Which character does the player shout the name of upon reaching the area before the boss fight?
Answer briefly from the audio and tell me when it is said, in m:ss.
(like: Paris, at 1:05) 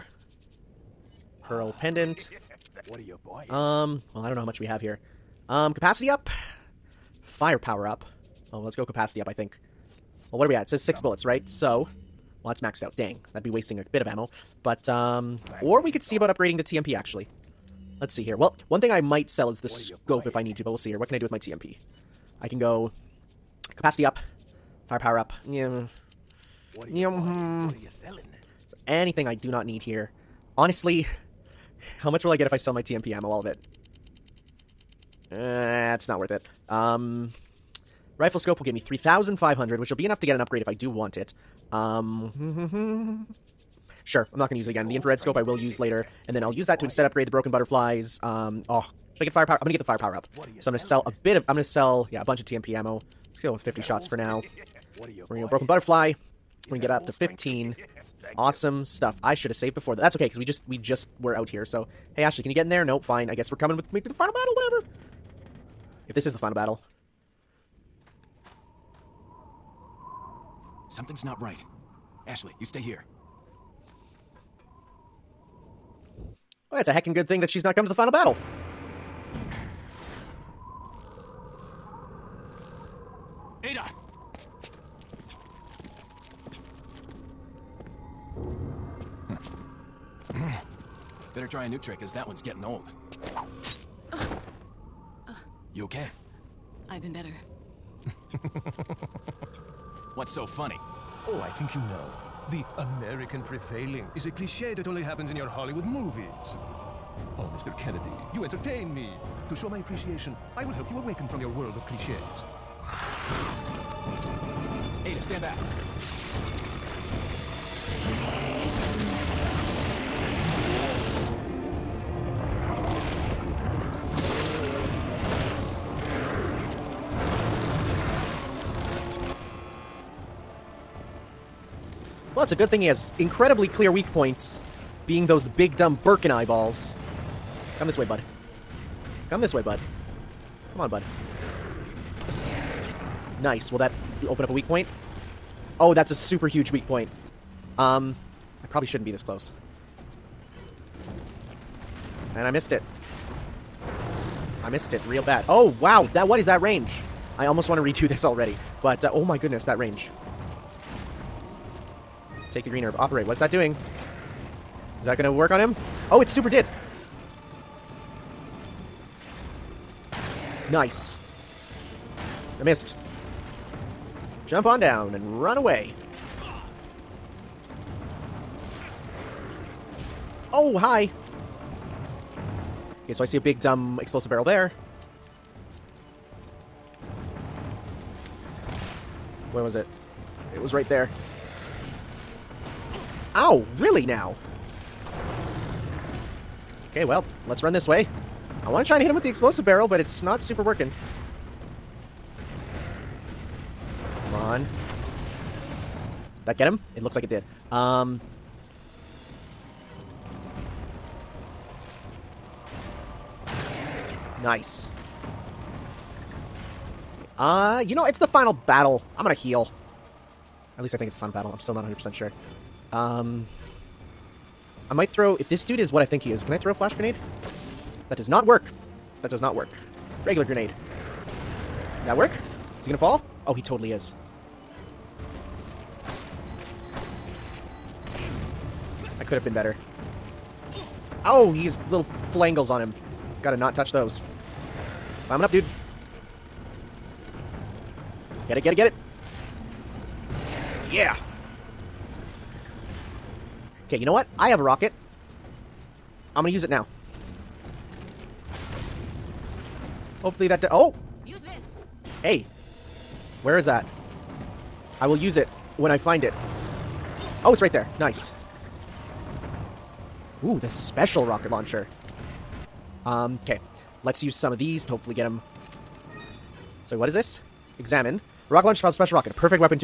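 Ada, at 1:23.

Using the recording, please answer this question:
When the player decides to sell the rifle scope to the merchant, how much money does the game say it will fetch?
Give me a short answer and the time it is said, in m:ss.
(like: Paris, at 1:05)
3,500, at 0:38.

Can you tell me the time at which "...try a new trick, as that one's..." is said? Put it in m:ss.
1:31.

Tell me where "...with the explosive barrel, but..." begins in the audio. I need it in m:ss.
3:19.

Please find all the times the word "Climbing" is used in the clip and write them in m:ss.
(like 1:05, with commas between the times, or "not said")
4:05.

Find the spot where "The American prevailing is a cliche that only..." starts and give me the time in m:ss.
1:42.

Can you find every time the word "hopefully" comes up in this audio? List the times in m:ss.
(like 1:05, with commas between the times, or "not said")
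4:20, 4:34.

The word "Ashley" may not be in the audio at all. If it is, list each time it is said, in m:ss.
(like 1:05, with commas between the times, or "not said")
1:02, 1:12.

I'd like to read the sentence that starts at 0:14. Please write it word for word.
But, um, or we could see about upgrading the TMP, actually.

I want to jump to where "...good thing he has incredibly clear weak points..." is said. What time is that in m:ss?
2:12.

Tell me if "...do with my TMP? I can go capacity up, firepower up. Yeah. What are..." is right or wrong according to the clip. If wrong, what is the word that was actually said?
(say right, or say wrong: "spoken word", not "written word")
right.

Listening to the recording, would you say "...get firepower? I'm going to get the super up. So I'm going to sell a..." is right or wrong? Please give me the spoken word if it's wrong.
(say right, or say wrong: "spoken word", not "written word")
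wrong: "firepower", not "super".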